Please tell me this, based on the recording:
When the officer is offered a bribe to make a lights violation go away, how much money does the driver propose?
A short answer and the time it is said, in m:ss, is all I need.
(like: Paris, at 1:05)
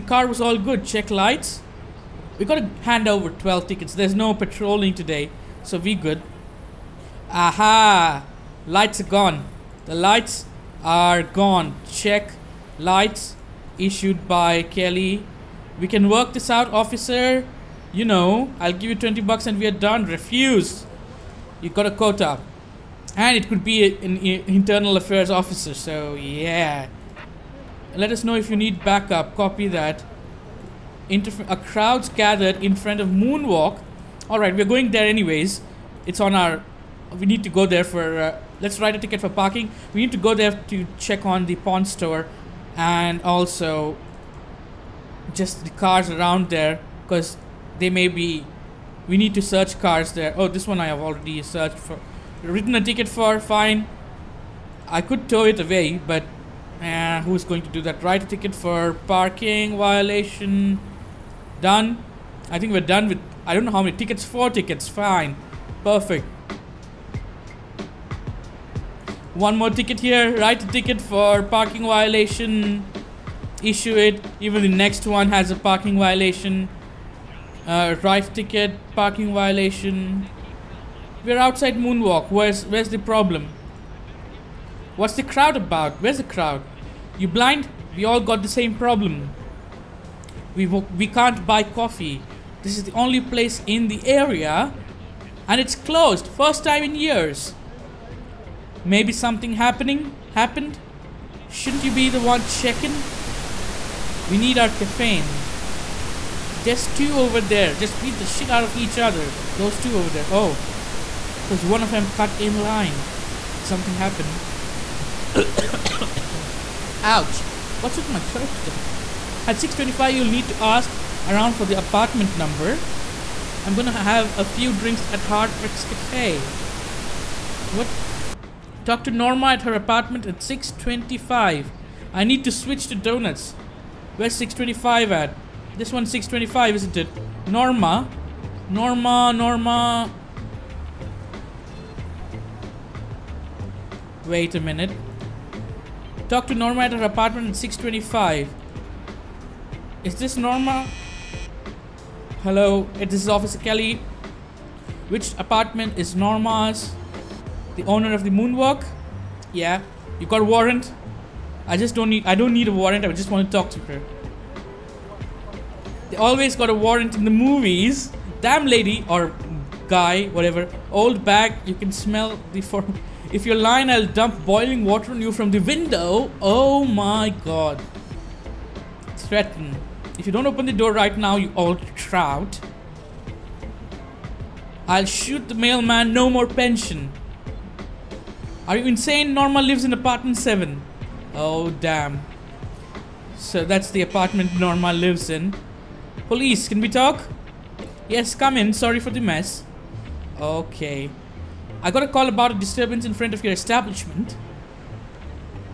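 $20, at 0:18.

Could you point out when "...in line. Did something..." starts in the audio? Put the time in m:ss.
1:52.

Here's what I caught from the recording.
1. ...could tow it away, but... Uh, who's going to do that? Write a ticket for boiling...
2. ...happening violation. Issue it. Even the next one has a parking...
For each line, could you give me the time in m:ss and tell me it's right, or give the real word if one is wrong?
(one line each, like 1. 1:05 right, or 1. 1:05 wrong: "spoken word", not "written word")
1. 0:55 wrong: "parking", not "boiling"
2. 1:11 wrong: "parking", not "happening".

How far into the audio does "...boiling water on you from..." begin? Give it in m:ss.
2:54.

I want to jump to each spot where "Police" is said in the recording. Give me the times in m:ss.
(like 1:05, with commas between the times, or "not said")
3:16.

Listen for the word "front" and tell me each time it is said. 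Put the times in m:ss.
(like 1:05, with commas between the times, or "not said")
0:32, 3:23.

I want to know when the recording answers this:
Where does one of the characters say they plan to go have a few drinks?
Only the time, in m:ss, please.
2:05.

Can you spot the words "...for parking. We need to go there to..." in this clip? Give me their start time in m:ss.
0:39.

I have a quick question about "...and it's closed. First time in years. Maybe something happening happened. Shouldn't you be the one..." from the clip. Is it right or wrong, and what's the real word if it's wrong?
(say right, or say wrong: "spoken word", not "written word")
right.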